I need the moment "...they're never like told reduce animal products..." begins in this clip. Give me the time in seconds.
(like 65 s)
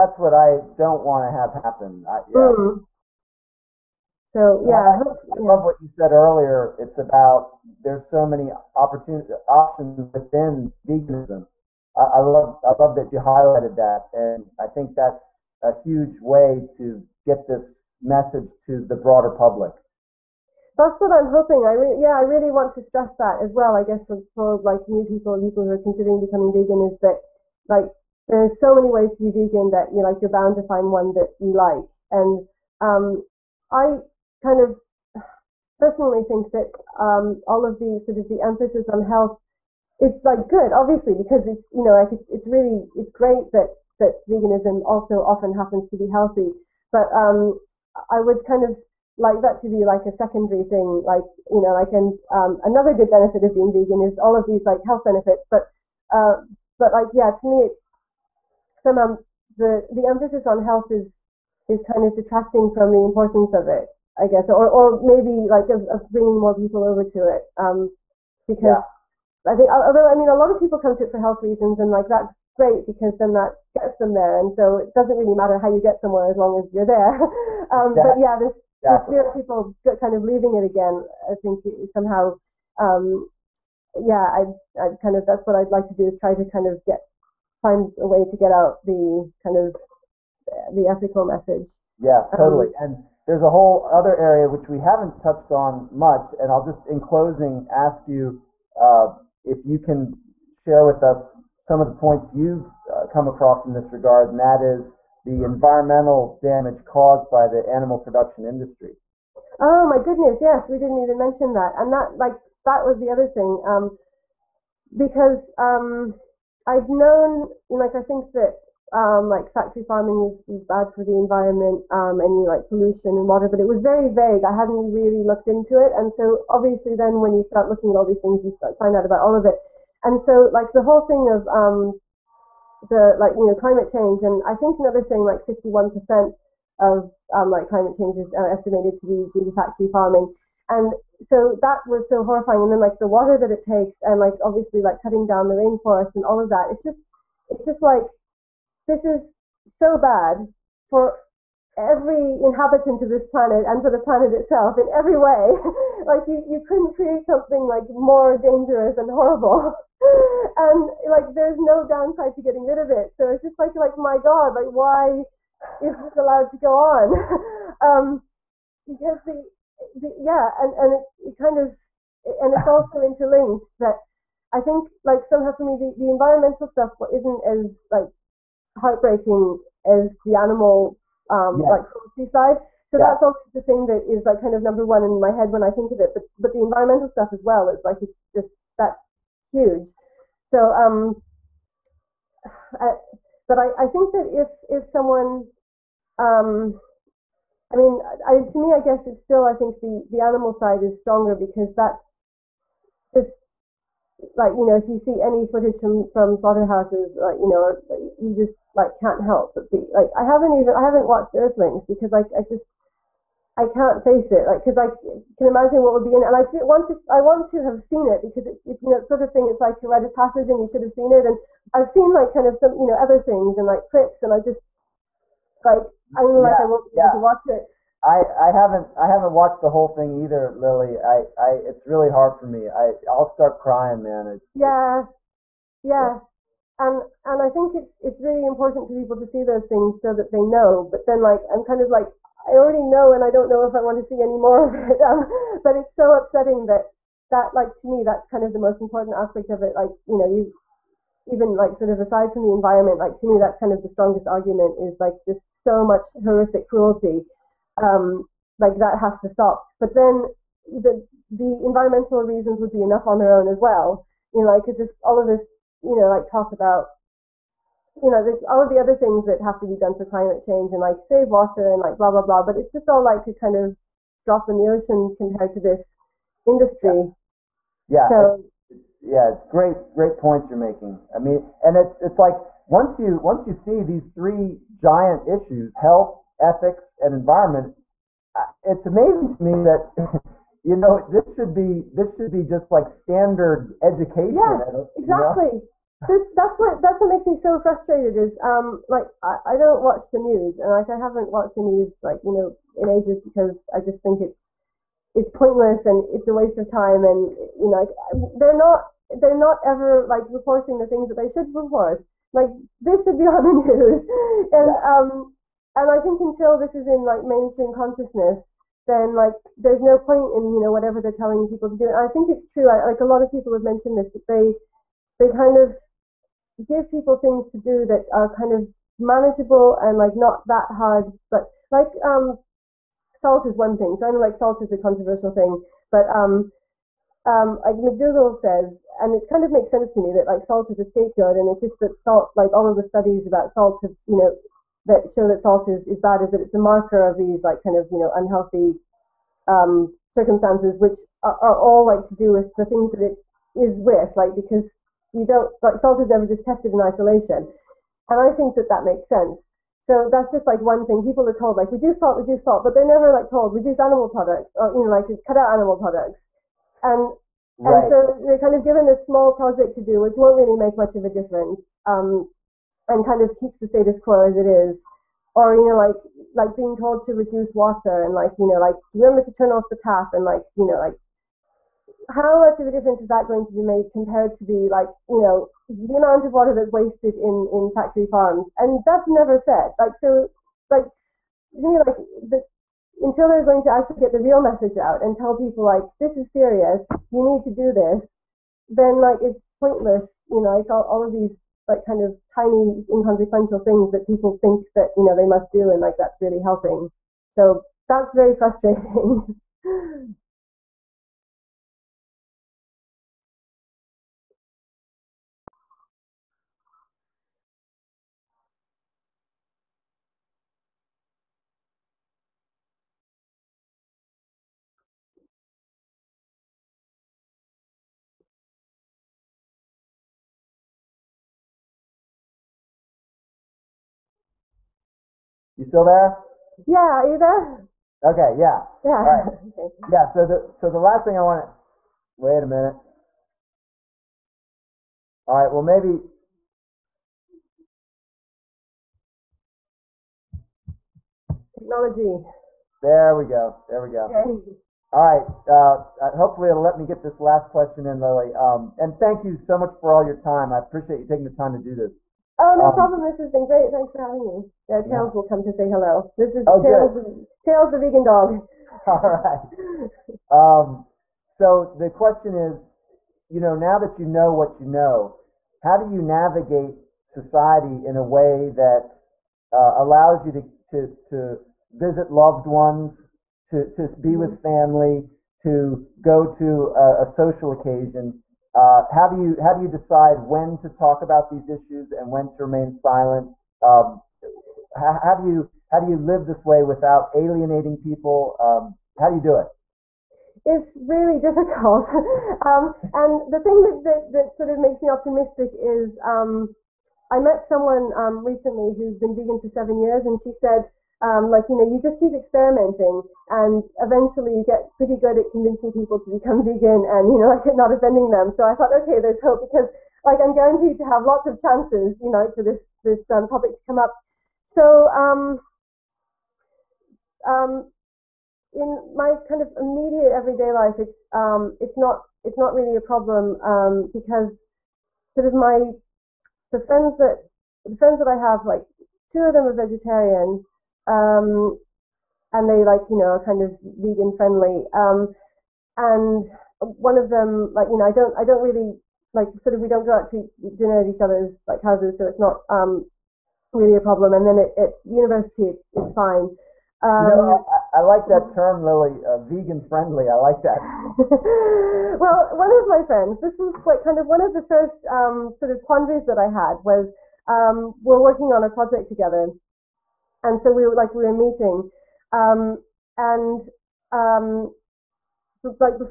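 362 s.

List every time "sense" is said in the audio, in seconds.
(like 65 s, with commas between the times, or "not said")
339 s, 359 s.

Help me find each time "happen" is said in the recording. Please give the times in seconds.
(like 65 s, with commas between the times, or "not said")
1 s, 45 s.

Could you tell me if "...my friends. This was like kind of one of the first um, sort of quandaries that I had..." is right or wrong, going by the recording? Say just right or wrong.
right.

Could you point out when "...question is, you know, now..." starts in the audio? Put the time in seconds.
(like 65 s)
471 s.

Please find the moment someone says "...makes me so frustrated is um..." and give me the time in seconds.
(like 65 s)
297 s.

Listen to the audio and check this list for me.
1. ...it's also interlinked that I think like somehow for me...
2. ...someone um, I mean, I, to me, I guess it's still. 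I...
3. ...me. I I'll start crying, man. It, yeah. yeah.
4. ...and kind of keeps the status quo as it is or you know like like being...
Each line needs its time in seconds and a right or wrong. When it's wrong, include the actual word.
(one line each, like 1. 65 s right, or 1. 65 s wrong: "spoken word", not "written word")
1. 172 s right
2. 194 s right
3. 232 s right
4. 372 s right.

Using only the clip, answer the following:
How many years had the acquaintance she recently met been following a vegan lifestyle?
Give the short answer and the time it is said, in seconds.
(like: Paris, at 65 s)
7, at 509 s.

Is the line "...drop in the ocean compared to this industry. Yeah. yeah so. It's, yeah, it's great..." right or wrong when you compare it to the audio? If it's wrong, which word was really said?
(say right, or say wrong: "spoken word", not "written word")
right.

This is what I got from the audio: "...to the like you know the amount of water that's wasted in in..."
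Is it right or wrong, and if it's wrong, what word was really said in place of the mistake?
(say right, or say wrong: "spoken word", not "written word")
right.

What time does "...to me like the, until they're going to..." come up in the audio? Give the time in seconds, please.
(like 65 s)
391 s.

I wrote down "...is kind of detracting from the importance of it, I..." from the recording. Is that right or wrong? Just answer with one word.
right.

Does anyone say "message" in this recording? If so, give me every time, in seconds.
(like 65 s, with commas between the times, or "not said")
18 s, 91 s, 394 s.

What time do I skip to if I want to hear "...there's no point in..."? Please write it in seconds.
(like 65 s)
319 s.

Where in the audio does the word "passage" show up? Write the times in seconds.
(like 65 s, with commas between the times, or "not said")
220 s.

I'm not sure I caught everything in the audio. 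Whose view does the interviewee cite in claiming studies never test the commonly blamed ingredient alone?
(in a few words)
McDougall.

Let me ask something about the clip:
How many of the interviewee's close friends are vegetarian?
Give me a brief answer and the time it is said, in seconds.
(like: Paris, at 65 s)
2, at 539 s.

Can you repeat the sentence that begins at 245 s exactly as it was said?
Um, but it's so upsetting that that like to me that's kind of the most important aspect of it.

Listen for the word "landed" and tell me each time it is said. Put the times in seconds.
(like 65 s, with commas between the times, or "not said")
not said.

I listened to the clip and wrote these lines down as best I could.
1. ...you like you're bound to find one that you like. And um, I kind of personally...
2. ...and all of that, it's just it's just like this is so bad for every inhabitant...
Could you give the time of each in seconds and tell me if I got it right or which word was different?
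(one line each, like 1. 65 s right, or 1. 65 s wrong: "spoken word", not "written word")
1. 29 s right
2. 146 s right.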